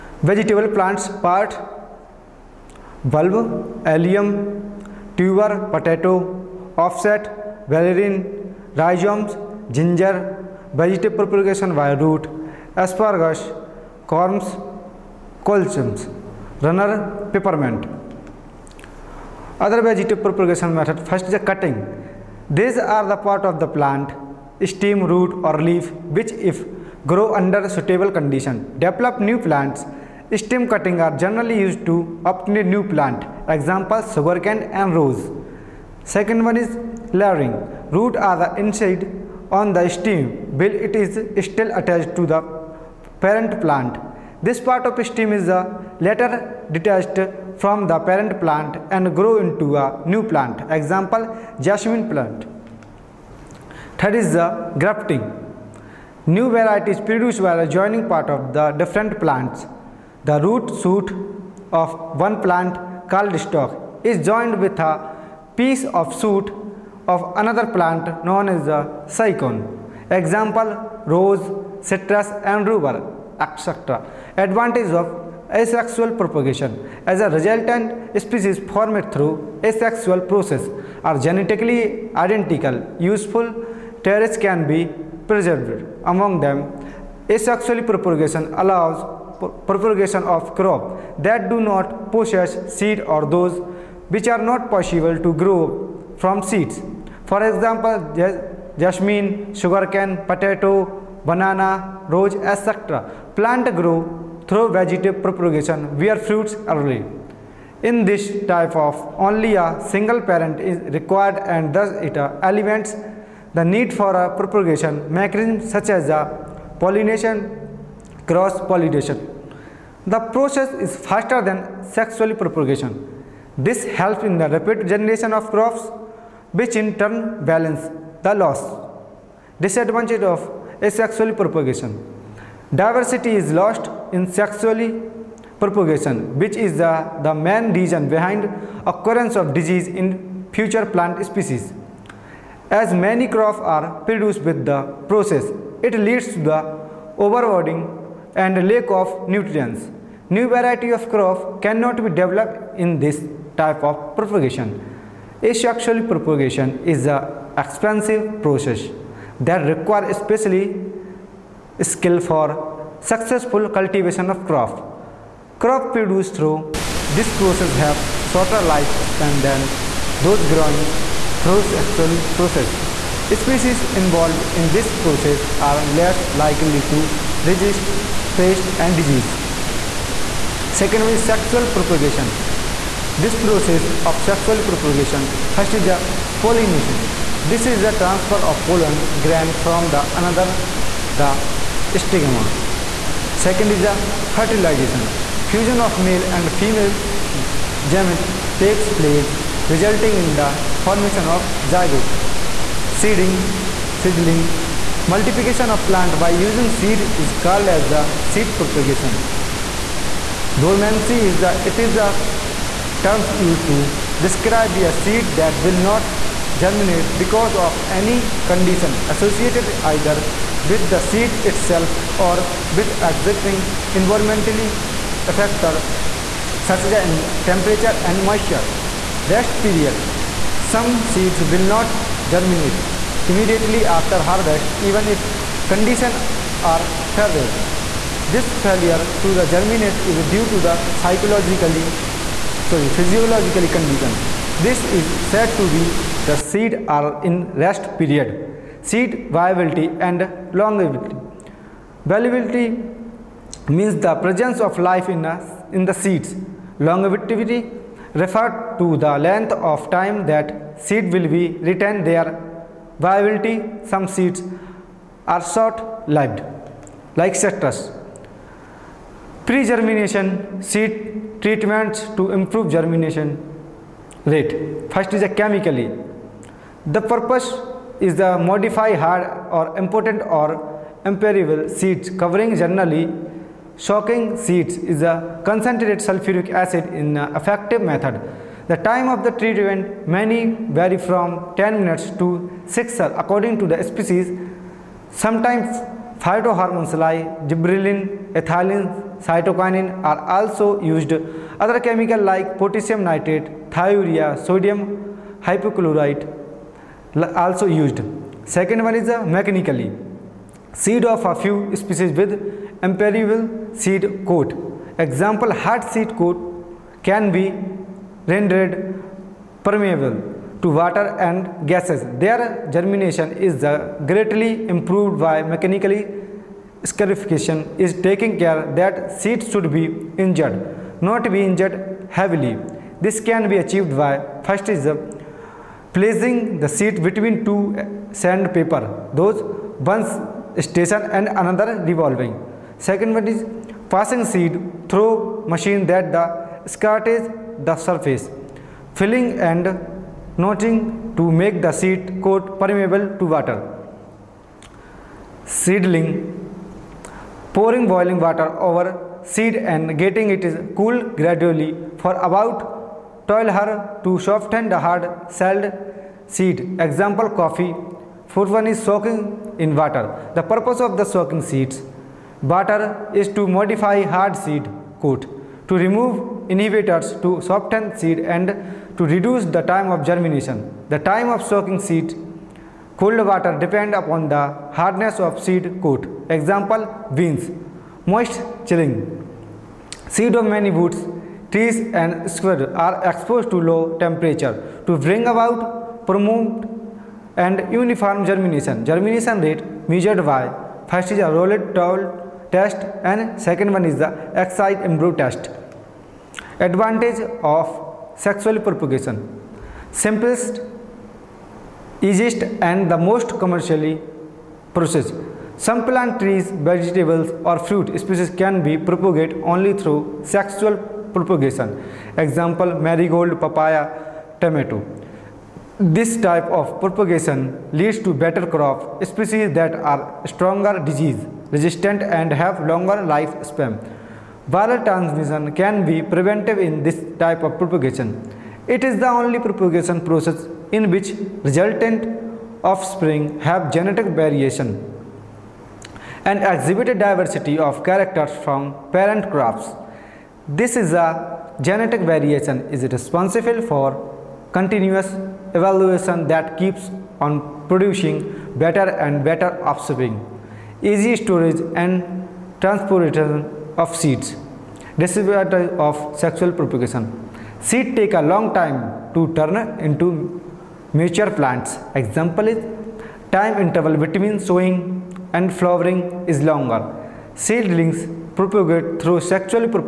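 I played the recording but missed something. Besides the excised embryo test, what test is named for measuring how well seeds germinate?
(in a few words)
Rolled towel test.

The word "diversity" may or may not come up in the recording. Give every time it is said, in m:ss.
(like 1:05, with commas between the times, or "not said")
2:12, 7:26.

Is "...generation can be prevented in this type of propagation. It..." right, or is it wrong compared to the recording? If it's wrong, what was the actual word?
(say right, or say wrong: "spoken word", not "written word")
wrong: "transmission", not "generation".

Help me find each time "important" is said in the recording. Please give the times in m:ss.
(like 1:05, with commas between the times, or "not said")
4:39.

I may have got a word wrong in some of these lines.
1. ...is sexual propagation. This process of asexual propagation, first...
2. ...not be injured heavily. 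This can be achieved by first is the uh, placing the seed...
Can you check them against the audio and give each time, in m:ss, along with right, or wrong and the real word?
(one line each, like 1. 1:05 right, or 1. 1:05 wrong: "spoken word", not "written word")
1. 3:01 wrong: "sexual", not "asexual"
2. 5:31 right.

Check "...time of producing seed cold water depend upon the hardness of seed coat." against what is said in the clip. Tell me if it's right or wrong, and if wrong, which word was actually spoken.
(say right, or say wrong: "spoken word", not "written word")
wrong: "soaking", not "producing".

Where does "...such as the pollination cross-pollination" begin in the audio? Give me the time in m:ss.
1:55.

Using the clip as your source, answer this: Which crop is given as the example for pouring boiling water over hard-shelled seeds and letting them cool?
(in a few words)
Coffee.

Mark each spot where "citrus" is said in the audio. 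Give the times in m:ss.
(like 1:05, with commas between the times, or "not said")
1:11, 4:27.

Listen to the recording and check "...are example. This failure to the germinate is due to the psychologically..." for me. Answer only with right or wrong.
wrong.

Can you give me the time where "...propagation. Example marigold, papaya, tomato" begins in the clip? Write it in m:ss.
7:01.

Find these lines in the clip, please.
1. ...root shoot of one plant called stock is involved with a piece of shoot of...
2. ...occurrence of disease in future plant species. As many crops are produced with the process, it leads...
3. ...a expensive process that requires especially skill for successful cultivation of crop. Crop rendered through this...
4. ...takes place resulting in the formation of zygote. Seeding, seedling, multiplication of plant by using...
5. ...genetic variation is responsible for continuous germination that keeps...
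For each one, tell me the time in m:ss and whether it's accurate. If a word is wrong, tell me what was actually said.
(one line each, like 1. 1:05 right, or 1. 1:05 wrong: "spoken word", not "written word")
1. 1:00 wrong: "joined", not "involved"
2. 2:18 right
3. 2:37 wrong: "produced", not "rendered"
4. 3:18 right
5. 7:31 wrong: "evaluation", not "germination".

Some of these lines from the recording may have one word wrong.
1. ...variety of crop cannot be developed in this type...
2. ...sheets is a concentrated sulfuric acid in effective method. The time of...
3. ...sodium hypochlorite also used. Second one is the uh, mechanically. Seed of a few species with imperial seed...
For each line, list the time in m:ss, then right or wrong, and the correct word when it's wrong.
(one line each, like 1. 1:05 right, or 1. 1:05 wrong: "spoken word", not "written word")
1. 2:30 right
2. 4:44 right
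3. 5:04 right.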